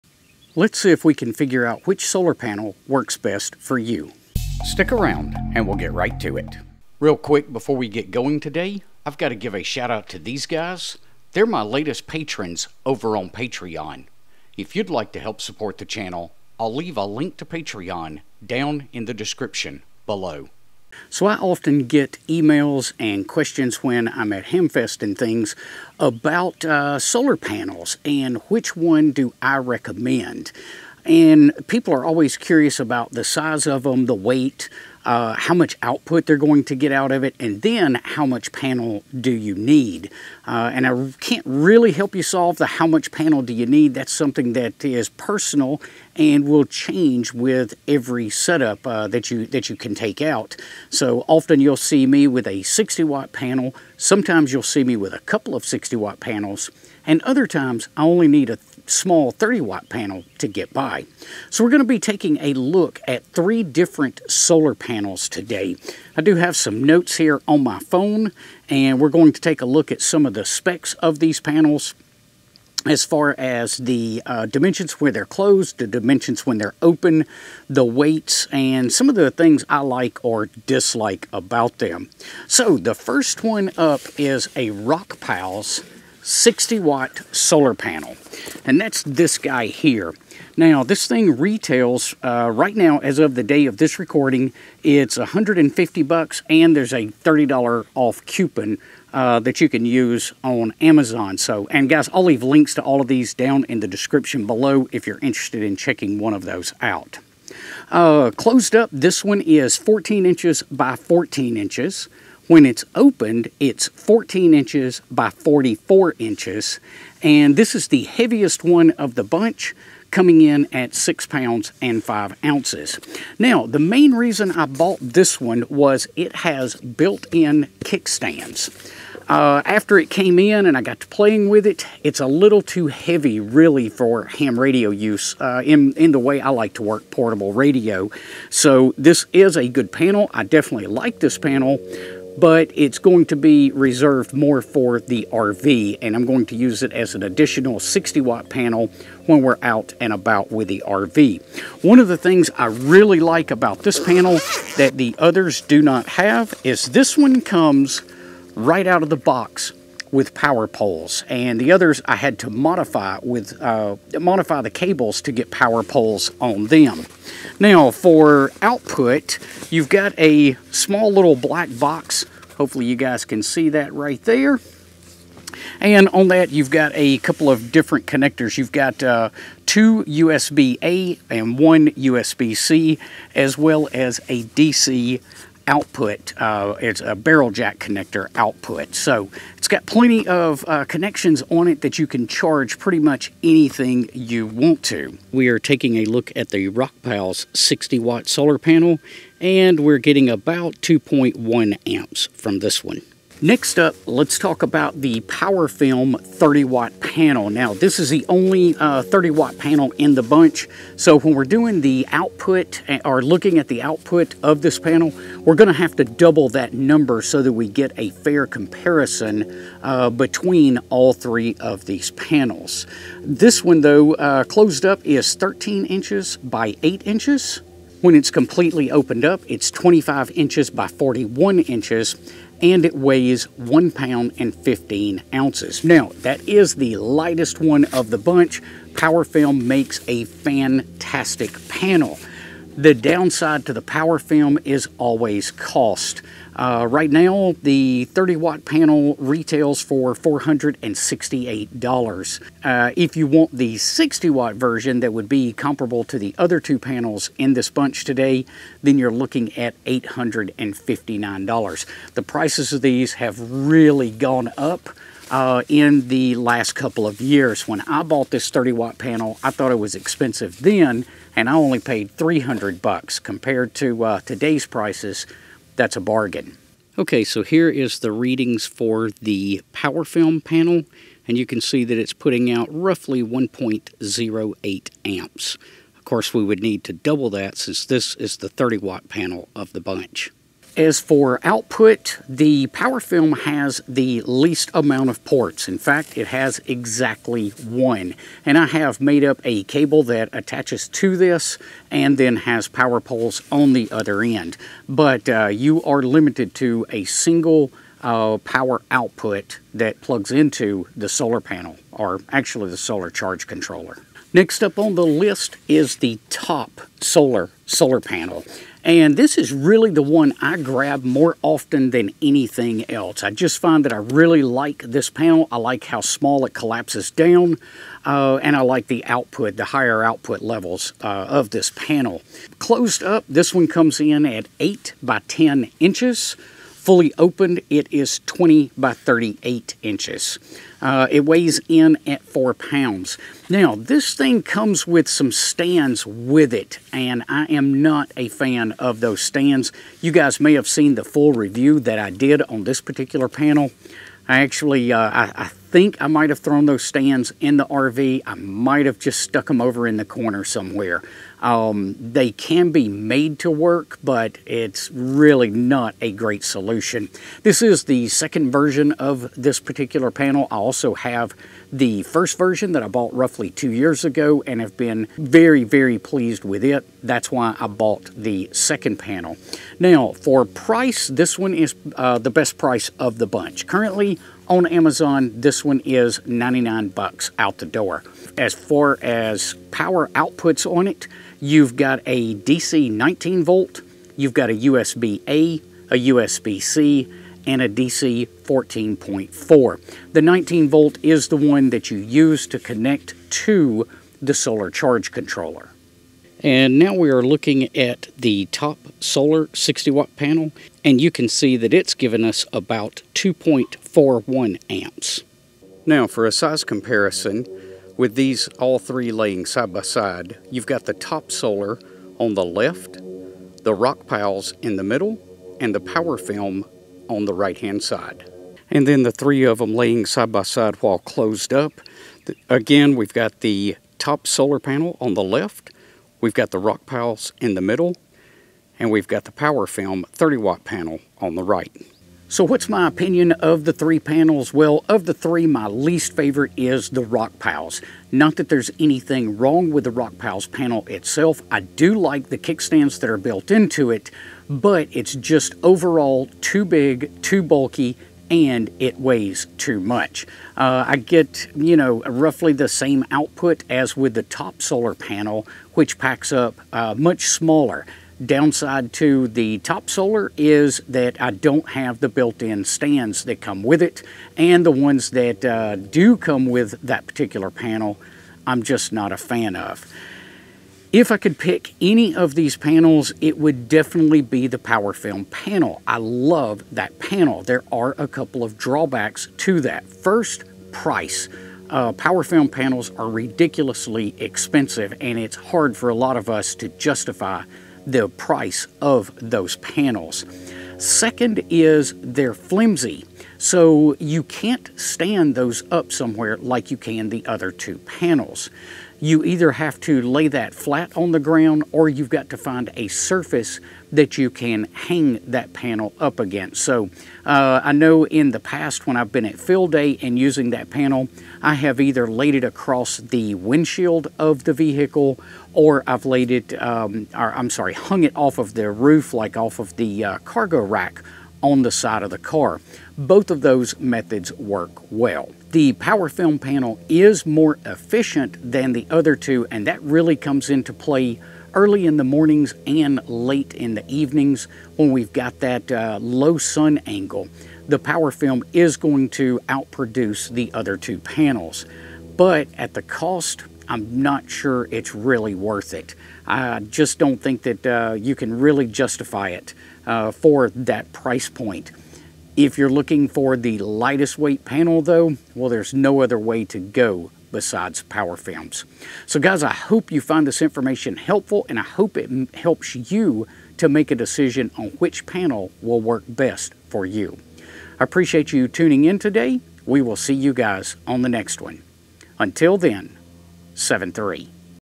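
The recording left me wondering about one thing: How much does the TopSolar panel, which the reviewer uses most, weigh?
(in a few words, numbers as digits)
4 pounds.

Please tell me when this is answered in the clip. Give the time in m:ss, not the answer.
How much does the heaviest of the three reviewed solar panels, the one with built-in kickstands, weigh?
2:00.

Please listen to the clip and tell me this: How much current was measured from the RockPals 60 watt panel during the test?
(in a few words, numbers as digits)
2.1 amps.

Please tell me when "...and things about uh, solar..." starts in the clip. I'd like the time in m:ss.
0:25.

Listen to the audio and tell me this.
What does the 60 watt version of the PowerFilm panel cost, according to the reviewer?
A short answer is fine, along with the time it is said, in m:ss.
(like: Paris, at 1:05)
$859, at 4:19.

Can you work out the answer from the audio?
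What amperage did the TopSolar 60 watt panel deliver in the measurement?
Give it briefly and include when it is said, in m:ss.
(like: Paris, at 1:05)
2.41 amps, at 6:53.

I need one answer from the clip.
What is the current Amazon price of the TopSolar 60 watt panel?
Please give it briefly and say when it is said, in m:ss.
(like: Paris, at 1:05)
$99, at 6:26.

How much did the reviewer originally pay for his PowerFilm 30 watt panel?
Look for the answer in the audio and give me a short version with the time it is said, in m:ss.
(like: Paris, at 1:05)
$300, at 4:32.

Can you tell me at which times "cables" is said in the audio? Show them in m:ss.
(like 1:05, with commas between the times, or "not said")
2:44, 4:59.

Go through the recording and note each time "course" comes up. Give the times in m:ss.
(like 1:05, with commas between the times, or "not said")
4:46.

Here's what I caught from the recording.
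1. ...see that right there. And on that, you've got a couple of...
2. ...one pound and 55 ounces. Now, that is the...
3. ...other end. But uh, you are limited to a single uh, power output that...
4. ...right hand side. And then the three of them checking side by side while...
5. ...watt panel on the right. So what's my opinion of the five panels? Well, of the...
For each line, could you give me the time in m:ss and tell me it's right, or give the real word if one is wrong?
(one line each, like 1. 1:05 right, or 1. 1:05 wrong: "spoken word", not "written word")
1. 2:53 right
2. 3:53 wrong: "15", not "55"
3. 5:03 right
4. 7:07 wrong: "laying", not "checking"
5. 7:20 wrong: "three", not "five".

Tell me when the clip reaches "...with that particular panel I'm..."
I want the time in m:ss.
7:56.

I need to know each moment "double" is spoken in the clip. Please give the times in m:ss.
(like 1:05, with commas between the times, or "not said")
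3:36, 4:46.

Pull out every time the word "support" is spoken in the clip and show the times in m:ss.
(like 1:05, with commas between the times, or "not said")
0:15.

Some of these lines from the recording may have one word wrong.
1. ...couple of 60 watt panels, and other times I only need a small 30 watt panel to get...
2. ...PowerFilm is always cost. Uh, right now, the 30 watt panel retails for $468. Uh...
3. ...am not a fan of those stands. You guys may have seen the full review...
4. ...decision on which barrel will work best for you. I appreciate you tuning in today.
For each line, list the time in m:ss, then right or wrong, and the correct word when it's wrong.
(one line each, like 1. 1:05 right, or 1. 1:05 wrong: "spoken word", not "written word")
1. 0:55 right
2. 4:03 right
3. 5:47 right
4. 9:33 wrong: "panel", not "barrel".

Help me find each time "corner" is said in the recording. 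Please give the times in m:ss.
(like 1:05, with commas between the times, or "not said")
6:00.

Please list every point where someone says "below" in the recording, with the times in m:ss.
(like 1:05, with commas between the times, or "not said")
0:20, 1:44.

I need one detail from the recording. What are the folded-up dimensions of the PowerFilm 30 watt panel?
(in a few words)
13 by 8 inches.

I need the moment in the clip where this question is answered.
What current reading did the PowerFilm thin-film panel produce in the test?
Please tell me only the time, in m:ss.
4:43.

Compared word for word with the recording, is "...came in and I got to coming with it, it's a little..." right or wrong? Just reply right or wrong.
wrong.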